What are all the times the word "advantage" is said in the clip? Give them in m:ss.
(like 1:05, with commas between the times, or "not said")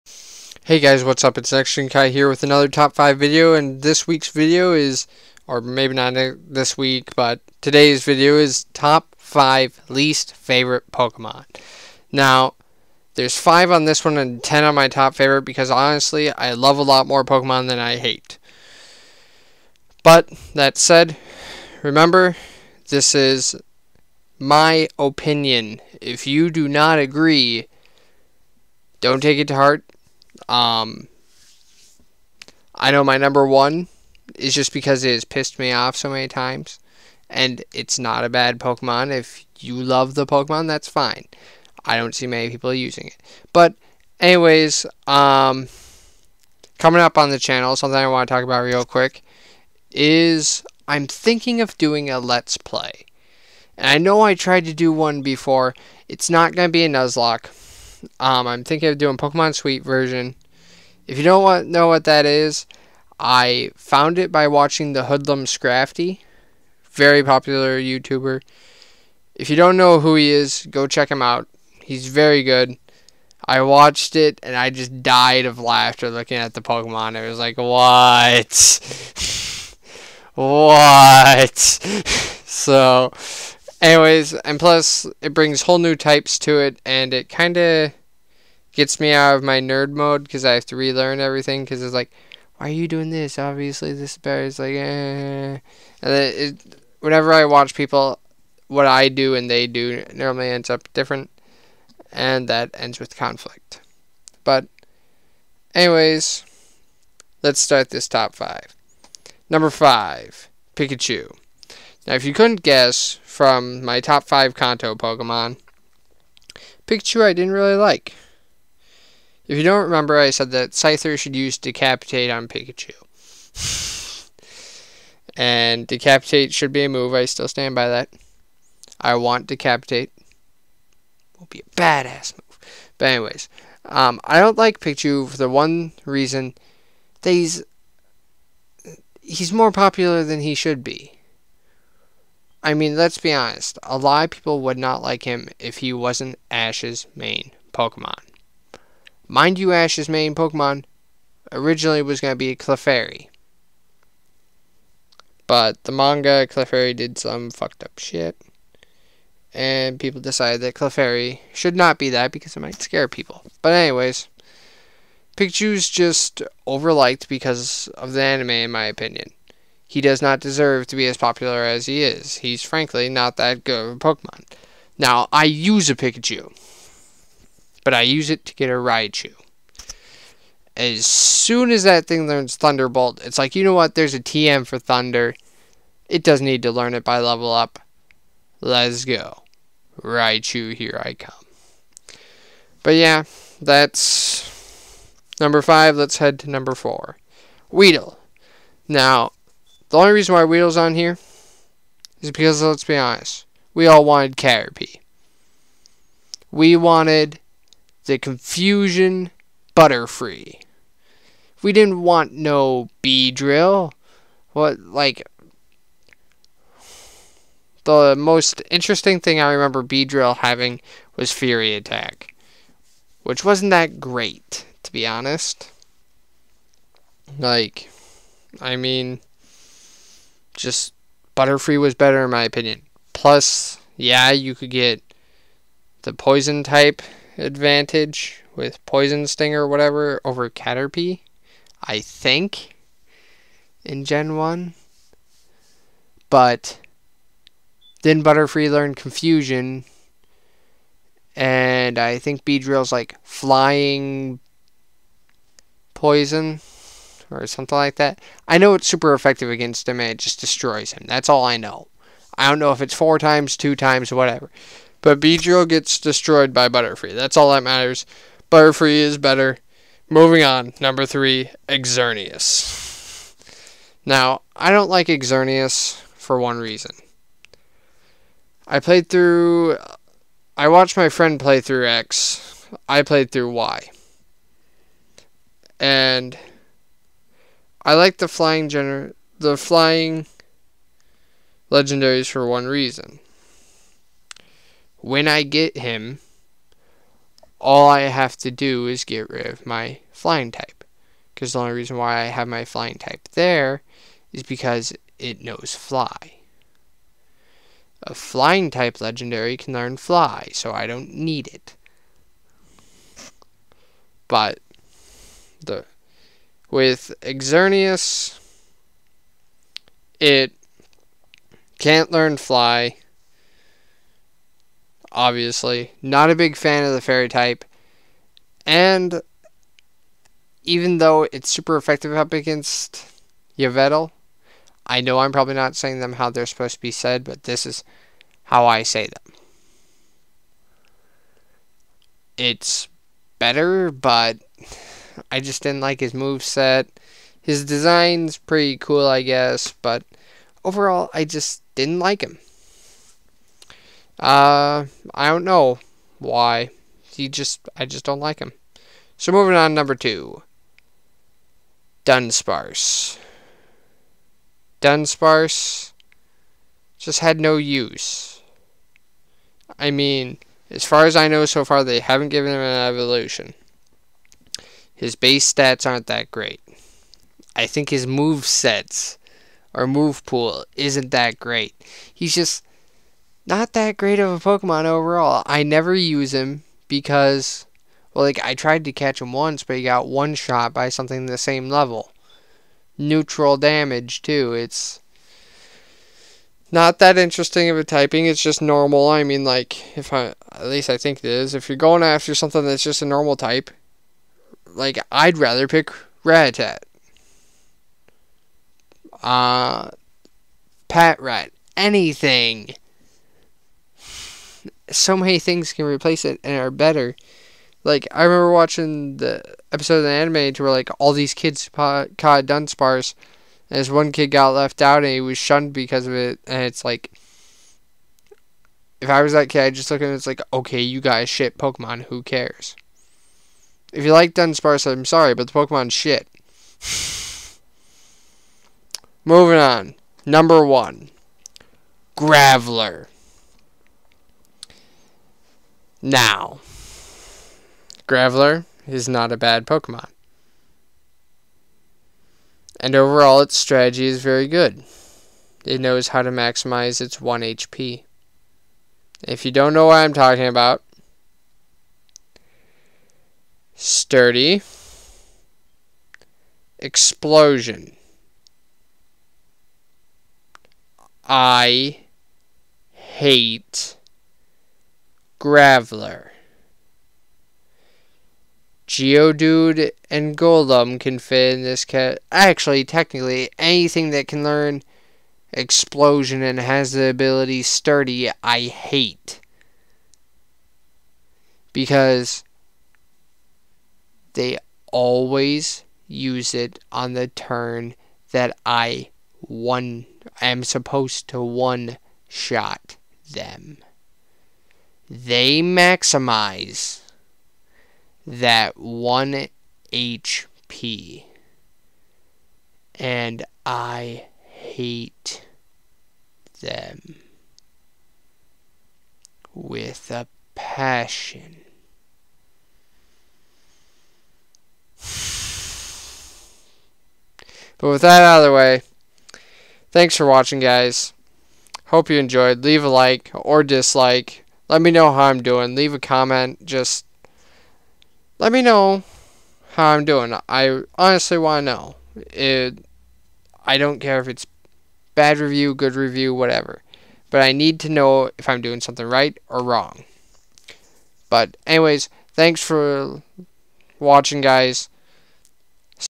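3:57.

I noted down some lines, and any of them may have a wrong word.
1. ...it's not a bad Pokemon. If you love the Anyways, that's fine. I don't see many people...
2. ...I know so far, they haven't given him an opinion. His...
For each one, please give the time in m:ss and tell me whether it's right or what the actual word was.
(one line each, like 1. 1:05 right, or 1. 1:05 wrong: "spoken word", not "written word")
1. 0:37 wrong: "Pokemon", not "Anyways"
2. 6:11 wrong: "evolution", not "opinion".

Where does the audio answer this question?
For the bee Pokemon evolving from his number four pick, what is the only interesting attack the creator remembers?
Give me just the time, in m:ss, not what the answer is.
3:41.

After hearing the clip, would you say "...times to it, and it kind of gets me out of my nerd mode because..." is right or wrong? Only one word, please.
wrong.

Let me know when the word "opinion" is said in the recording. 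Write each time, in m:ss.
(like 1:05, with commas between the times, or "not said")
0:24, 2:48, 3:52.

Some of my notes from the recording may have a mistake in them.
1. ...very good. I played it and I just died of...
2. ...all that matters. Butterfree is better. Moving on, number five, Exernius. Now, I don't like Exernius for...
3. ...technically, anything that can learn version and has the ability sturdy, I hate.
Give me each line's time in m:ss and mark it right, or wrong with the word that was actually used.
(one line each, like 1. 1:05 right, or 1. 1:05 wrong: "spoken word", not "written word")
1. 1:12 wrong: "watched", not "played"
2. 4:27 wrong: "three", not "five"
3. 8:02 wrong: "explosion", not "version".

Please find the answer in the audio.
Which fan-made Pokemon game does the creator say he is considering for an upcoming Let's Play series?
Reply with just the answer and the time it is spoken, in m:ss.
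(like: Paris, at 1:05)
Pokemon Sweet version, at 0:59.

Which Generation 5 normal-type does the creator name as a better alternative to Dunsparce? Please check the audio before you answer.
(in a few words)
Patrat.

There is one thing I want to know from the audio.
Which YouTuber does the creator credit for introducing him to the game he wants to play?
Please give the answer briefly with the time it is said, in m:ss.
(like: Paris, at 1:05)
Hoodlum Scrafty, at 1:05.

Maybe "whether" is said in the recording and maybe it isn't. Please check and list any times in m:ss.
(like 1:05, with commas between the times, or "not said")
not said.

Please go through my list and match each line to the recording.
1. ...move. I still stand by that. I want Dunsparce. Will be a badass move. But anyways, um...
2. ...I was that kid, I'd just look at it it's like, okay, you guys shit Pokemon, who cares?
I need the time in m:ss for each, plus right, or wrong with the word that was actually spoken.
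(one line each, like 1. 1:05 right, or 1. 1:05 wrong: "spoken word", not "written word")
1. 2:06 wrong: "Decapitate", not "Dunsparce"
2. 7:09 right.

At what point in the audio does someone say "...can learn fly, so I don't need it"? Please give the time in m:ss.
5:09.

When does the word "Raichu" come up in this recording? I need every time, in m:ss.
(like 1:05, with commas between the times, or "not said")
2:58, 3:10.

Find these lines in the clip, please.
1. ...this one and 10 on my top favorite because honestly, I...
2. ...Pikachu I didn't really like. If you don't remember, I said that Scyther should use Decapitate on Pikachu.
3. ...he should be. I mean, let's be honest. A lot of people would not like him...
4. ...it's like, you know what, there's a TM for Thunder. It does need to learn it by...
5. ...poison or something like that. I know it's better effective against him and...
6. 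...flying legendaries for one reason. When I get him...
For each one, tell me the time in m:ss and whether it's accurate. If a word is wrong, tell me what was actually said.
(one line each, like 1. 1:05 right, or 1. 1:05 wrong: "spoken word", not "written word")
1. 0:13 right
2. 1:56 right
3. 2:20 right
4. 3:03 right
5. 4:15 wrong: "super", not "better"
6. 4:49 right.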